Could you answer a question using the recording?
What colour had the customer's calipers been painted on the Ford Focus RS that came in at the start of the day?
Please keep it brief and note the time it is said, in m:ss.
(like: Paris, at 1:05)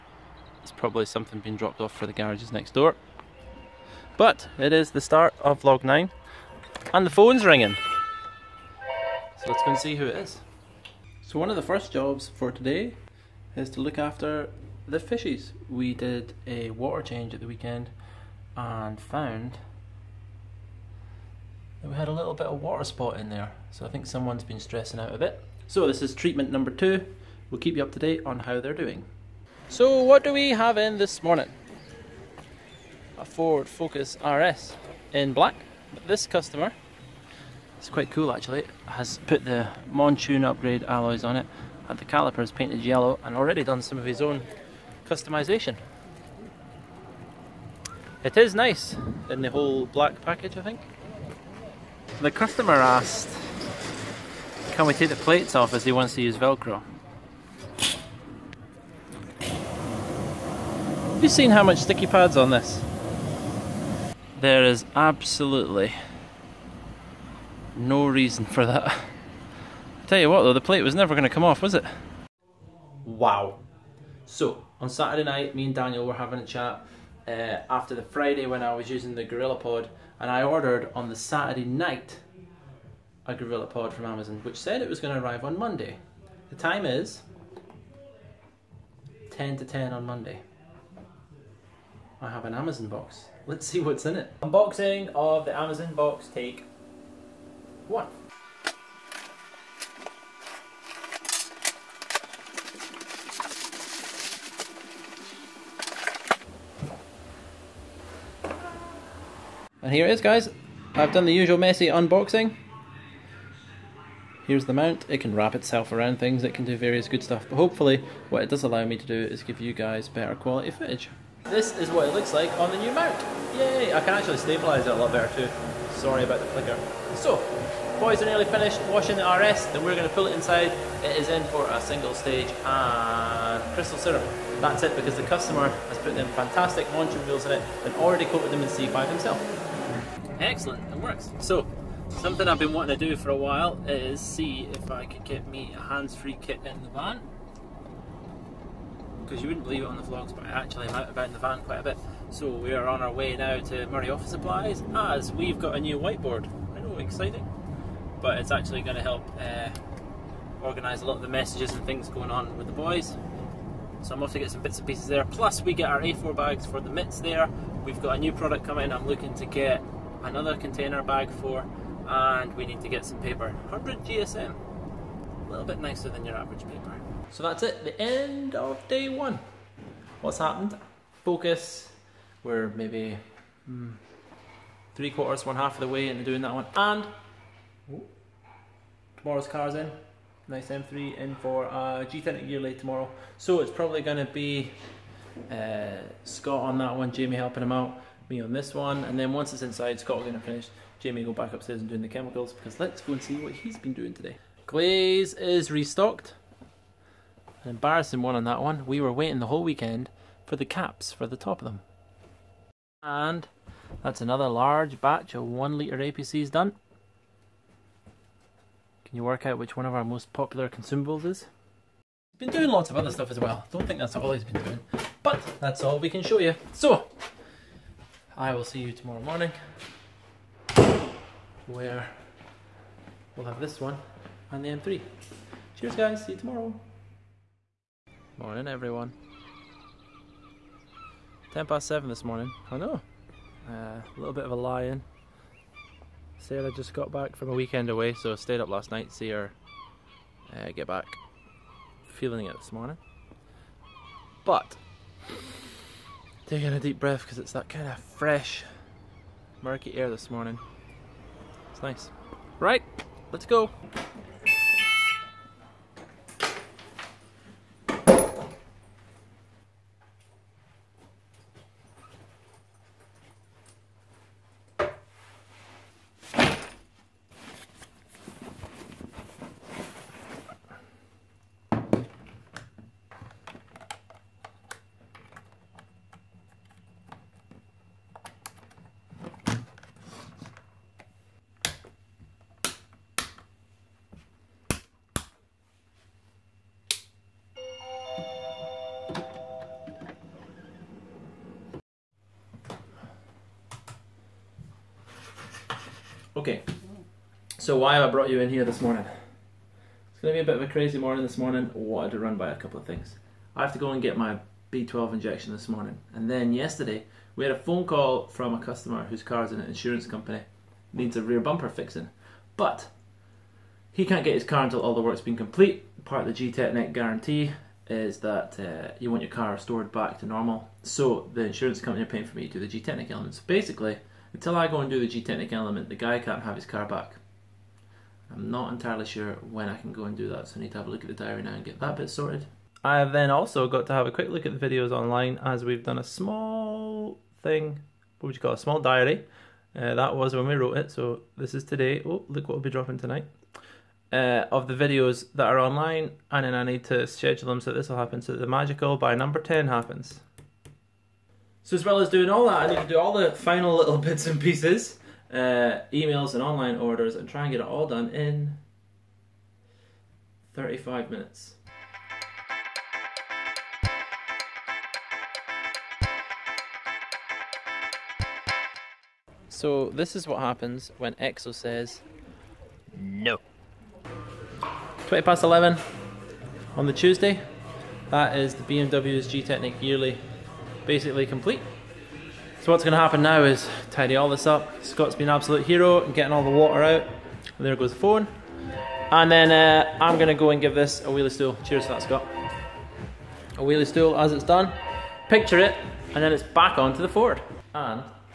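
Yellow, at 0:42.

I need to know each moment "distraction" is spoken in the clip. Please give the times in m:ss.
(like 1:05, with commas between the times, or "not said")
not said.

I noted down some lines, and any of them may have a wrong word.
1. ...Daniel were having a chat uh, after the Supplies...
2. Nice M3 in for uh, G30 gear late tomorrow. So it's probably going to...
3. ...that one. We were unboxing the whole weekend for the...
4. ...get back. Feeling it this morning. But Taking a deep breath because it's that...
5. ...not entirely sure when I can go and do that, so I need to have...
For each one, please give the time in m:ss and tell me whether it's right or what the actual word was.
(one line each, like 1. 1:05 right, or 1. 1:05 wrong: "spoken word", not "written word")
1. 1:15 wrong: "Friday", not "Supplies"
2. 3:10 right
3. 3:28 wrong: "waiting", not "unboxing"
4. 4:10 right
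5. 5:38 right.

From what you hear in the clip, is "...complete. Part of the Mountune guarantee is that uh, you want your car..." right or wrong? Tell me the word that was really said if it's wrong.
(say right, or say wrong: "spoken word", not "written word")
wrong: "Gtechniq", not "Mountune".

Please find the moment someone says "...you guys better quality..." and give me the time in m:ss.
1:59.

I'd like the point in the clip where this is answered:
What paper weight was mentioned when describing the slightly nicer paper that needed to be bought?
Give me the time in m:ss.
2:53.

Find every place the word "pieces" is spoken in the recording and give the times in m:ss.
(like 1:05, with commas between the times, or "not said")
2:44, 6:04.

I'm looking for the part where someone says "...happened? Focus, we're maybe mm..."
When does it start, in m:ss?
3:00.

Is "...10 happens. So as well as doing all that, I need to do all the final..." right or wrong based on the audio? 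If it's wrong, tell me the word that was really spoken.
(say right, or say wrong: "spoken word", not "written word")
right.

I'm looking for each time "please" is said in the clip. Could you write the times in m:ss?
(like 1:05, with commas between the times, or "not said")
not said.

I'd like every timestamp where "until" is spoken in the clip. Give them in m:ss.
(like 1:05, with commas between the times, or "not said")
5:24, 5:34.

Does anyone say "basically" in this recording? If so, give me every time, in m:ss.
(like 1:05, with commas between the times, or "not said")
5:33, 6:30.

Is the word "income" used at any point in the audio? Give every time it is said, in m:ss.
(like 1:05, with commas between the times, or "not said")
not said.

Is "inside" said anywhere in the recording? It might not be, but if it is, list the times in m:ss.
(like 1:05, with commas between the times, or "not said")
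2:10, 3:19.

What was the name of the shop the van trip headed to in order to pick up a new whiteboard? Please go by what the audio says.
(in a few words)
Moray Office Supplies.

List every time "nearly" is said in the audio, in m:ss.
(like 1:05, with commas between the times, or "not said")
2:08.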